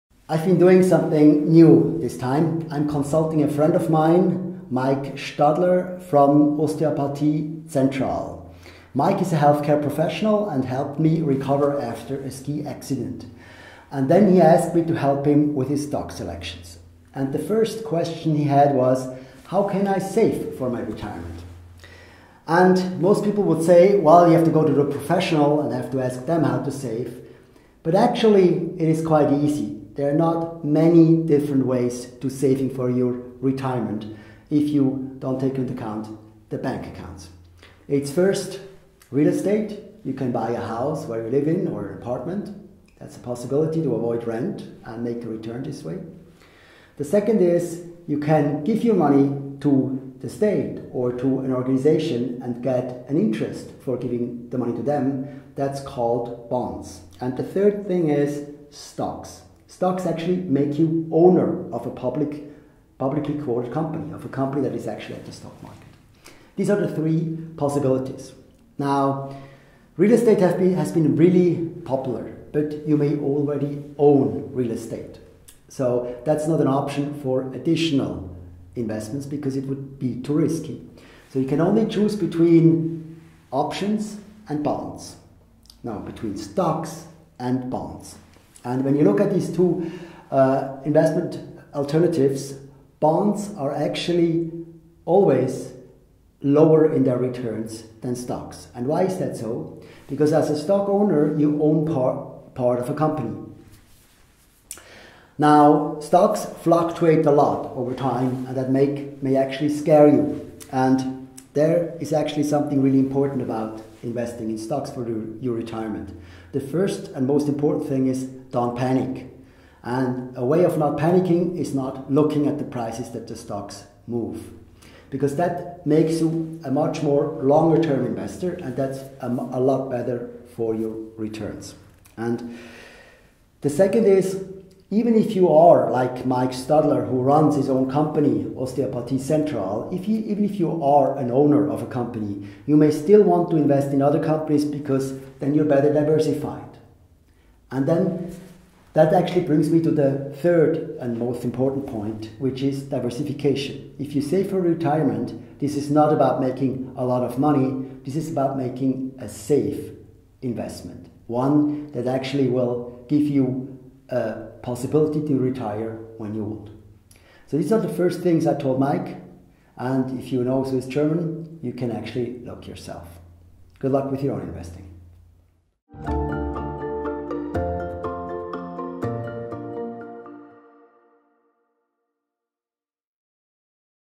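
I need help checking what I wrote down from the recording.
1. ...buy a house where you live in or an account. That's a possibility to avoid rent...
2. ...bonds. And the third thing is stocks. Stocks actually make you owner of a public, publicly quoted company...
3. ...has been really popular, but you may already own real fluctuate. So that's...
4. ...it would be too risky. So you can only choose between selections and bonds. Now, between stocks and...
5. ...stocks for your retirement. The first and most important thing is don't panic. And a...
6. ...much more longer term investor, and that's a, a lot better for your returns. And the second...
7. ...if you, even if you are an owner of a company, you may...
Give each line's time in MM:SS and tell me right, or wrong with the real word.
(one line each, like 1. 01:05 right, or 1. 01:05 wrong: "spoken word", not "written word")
1. 00:40 wrong: "apartment", not "account"
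2. 00:56 right
3. 01:10 wrong: "estate", not "fluctuate"
4. 01:19 wrong: "options", not "selections"
5. 01:54 right
6. 02:06 right
7. 02:19 right.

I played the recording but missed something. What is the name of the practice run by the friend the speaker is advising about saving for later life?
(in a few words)
Osteopathie Central.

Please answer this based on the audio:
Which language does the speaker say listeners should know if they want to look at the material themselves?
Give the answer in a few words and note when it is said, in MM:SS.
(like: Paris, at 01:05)
Swiss German, at 02:50.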